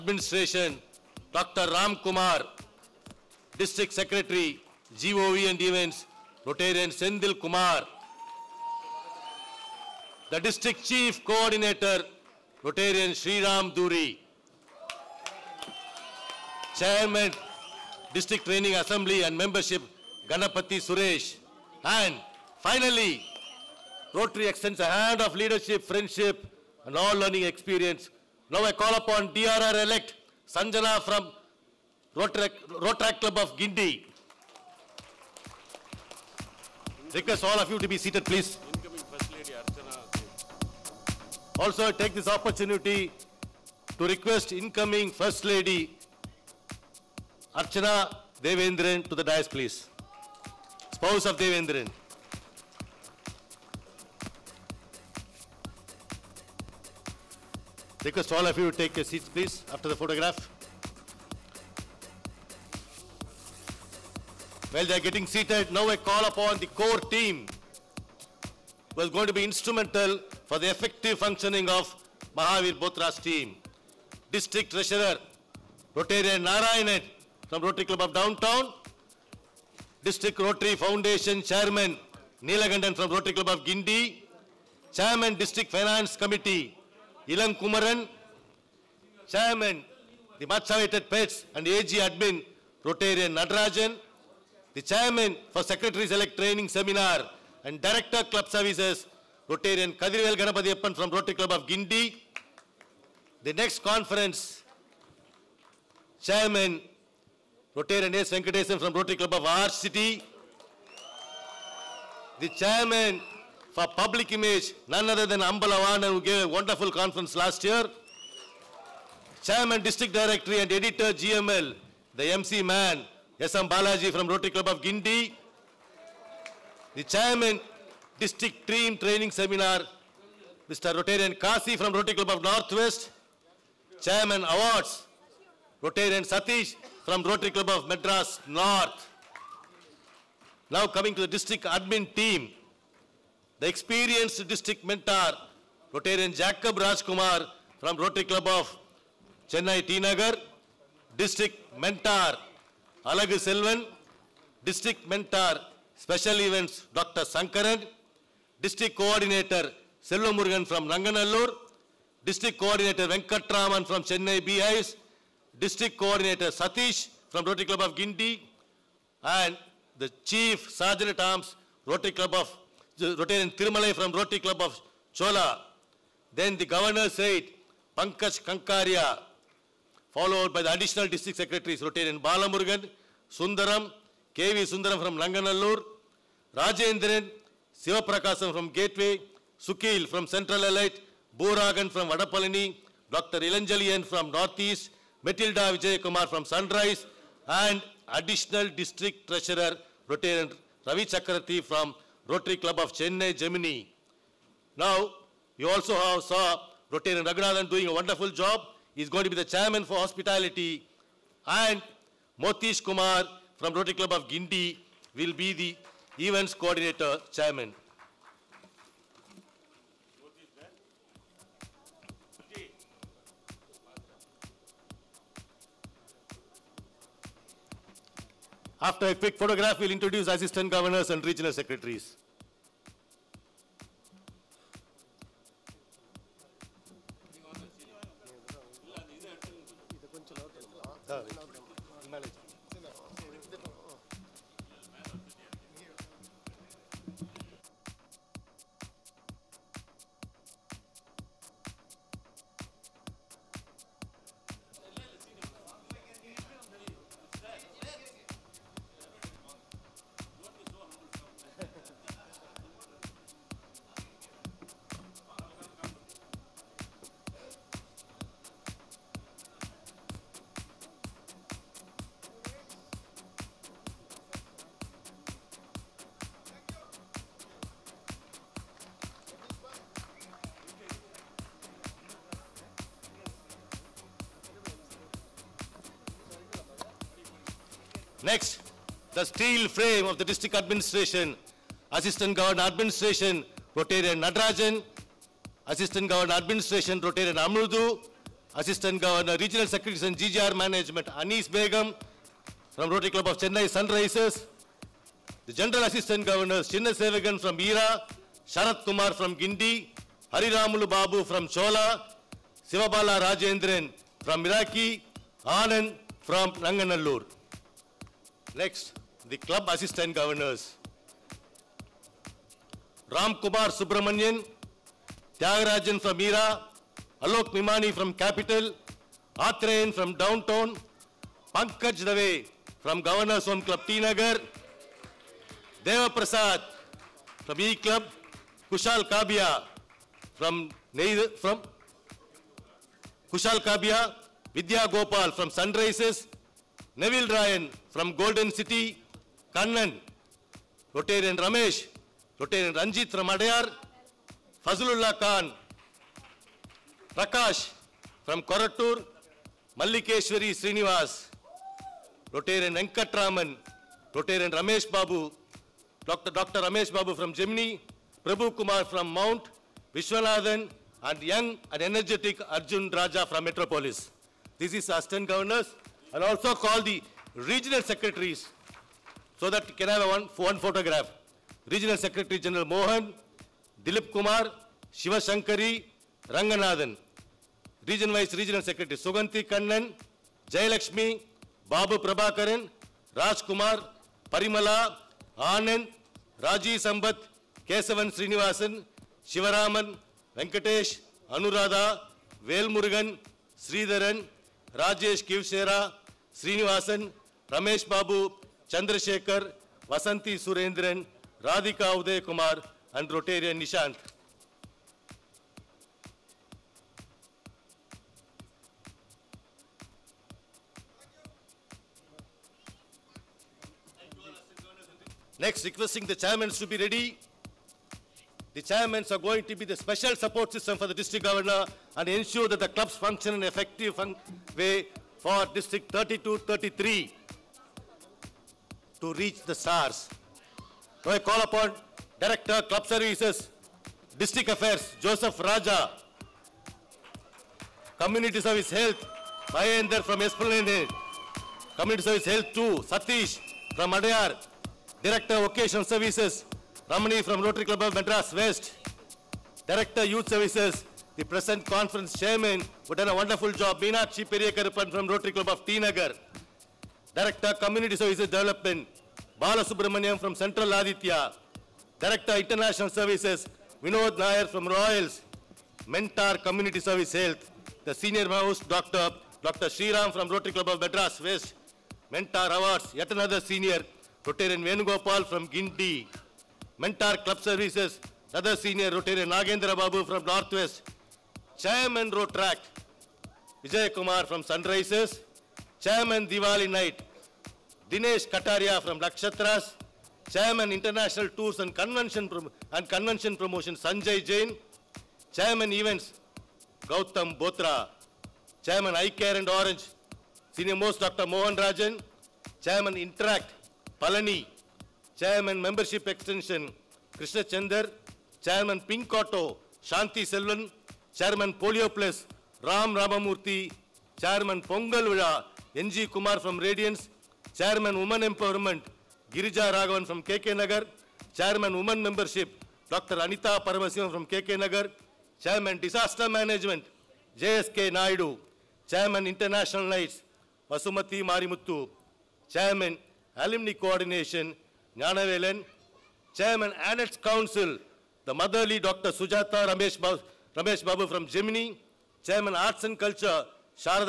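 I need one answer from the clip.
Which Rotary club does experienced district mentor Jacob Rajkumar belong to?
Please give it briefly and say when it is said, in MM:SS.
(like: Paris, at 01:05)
Rotary Club of Chennai T Nagar, at 02:27.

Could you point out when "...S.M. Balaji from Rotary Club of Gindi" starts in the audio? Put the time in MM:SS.
02:03.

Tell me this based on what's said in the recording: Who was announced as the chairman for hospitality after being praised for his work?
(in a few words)
Raghunathan.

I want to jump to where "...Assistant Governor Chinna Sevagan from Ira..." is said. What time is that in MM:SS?
05:05.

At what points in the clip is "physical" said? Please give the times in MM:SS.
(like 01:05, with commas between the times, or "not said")
not said.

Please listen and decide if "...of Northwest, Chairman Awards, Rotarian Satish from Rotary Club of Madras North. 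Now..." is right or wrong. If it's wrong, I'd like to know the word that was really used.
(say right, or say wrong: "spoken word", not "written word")
right.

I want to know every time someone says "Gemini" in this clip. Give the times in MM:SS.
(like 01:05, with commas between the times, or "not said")
03:23, 06:07, 09:11.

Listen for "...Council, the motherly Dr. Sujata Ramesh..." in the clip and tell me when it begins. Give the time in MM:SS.
09:07.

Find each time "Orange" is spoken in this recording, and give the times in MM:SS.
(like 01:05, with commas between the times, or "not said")
08:29.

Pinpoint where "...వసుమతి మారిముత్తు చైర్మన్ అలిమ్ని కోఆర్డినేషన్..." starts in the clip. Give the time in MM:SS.
09:00.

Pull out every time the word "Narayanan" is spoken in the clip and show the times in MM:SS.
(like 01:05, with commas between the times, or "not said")
01:16.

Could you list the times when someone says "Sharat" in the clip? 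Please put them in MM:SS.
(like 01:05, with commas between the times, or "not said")
05:08.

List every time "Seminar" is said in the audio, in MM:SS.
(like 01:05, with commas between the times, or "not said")
01:36, 02:09.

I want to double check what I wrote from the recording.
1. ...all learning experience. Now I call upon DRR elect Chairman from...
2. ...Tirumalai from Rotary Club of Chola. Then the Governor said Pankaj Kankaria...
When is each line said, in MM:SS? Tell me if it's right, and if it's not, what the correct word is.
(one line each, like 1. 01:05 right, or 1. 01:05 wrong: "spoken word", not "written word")
1. 00:26 wrong: "Sanjana", not "Chairman"
2. 02:53 right.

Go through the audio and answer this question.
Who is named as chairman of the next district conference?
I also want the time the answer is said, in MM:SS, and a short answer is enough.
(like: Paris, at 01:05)
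S. Venkatesan, at 01:48.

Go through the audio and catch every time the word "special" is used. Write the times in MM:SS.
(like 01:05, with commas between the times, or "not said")
02:35, 07:09.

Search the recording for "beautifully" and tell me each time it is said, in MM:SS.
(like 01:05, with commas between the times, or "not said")
not said.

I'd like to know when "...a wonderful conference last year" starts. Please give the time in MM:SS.
01:56.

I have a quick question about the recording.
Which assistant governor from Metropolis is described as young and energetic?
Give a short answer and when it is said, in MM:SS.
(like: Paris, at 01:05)
Arjun Raja, at 06:12.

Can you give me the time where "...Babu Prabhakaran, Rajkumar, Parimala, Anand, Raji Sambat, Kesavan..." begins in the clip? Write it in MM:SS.
06:31.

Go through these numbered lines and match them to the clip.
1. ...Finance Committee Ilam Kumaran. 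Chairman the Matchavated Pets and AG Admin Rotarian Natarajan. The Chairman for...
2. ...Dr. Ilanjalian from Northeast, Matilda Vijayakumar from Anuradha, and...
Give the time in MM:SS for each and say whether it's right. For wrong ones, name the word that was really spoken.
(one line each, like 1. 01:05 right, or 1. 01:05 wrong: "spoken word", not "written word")
1. 01:25 right
2. 03:13 wrong: "Sunrise", not "Anuradha".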